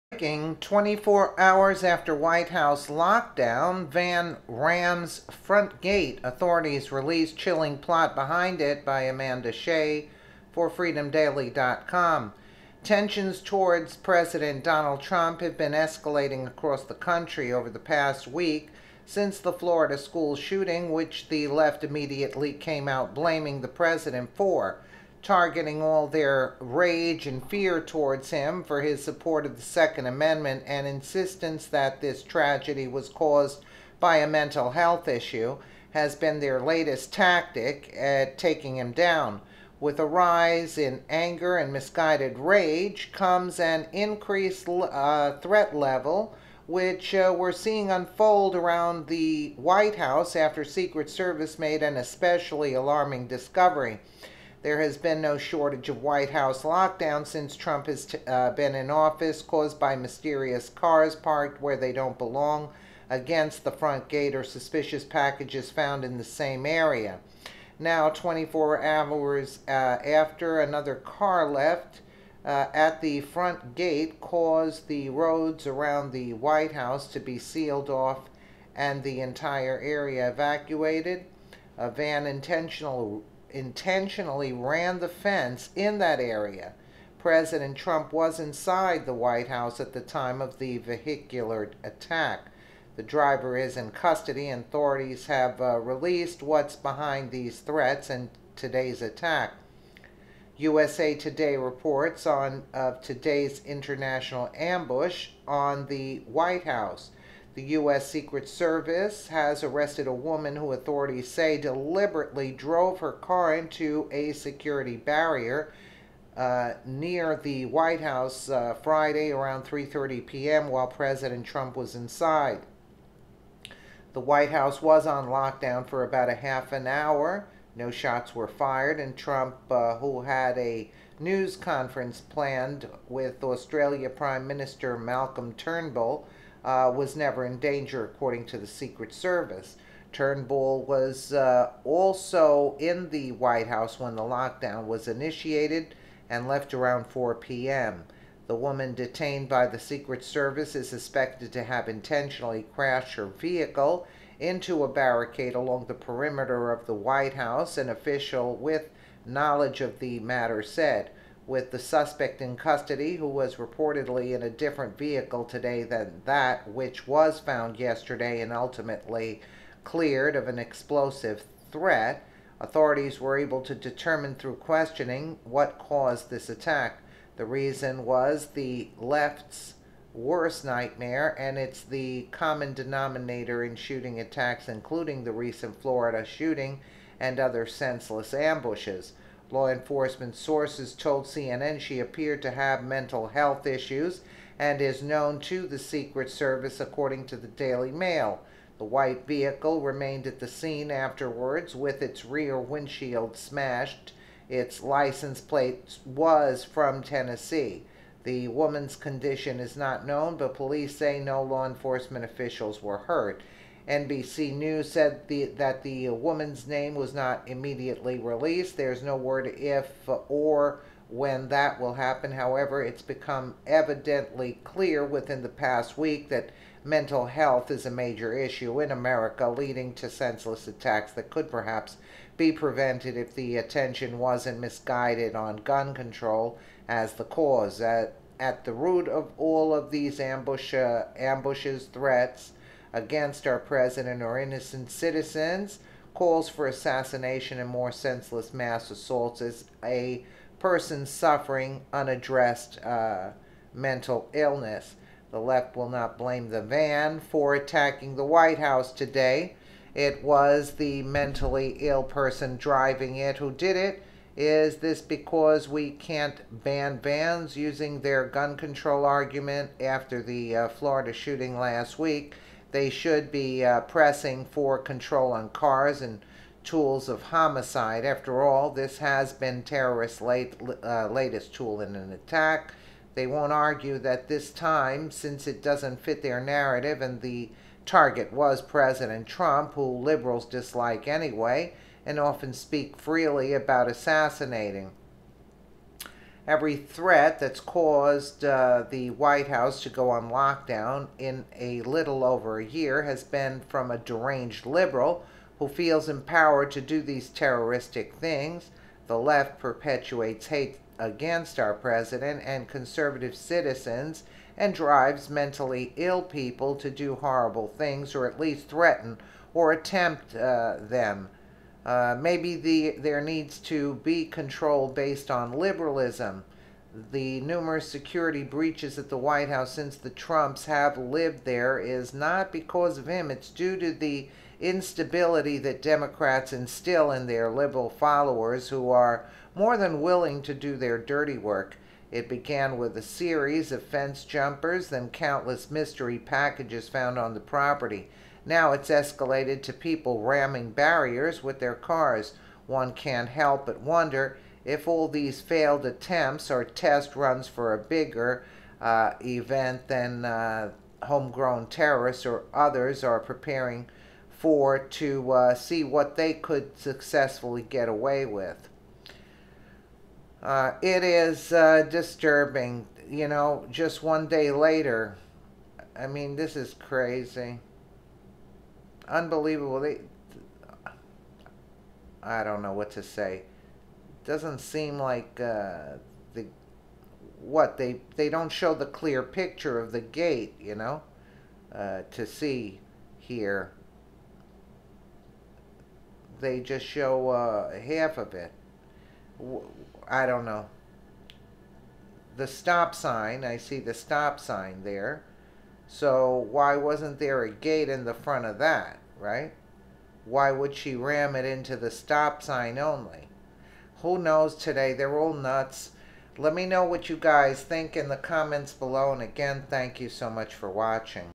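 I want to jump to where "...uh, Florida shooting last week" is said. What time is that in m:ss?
4:30.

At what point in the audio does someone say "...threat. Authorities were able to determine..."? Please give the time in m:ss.
2:51.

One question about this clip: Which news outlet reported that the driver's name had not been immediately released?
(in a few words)
NBC News.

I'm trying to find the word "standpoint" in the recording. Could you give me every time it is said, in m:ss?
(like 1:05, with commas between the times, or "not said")
not said.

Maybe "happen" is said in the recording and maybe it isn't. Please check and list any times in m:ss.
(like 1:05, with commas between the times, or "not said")
3:41.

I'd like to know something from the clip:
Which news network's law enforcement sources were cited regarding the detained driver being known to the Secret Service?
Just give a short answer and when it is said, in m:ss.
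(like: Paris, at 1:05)
CNN, at 3:11.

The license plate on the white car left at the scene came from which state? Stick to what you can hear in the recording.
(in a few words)
Tennessee.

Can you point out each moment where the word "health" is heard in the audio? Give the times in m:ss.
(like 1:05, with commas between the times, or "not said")
0:34, 3:13, 3:47.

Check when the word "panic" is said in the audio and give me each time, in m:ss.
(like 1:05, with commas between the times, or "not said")
not said.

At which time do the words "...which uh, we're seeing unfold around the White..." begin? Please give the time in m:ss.
0:46.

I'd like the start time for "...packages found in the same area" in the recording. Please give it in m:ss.
1:05.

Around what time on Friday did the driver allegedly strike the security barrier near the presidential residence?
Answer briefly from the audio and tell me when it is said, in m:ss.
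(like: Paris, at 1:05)
3:30 p.m., at 1:59.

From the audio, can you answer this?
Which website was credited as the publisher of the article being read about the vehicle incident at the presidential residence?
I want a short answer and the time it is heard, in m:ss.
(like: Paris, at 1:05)
freedomdaily.com, at 0:10.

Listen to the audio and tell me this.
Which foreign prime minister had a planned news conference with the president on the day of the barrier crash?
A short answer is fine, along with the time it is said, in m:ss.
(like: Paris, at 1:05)
Malcolm Turnbull, at 2:14.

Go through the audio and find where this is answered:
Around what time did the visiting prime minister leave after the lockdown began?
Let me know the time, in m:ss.
2:27.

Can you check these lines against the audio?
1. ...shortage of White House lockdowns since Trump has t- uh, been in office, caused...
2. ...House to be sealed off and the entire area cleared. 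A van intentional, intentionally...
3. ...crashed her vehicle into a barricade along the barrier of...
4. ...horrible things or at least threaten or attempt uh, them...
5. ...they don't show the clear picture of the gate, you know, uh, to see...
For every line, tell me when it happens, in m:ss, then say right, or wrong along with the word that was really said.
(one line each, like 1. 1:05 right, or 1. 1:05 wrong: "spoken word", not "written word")
1. 0:55 right
2. 1:16 wrong: "evacuated", not "cleared"
3. 2:32 wrong: "perimeter", not "barrier"
4. 5:17 right
5. 6:28 right.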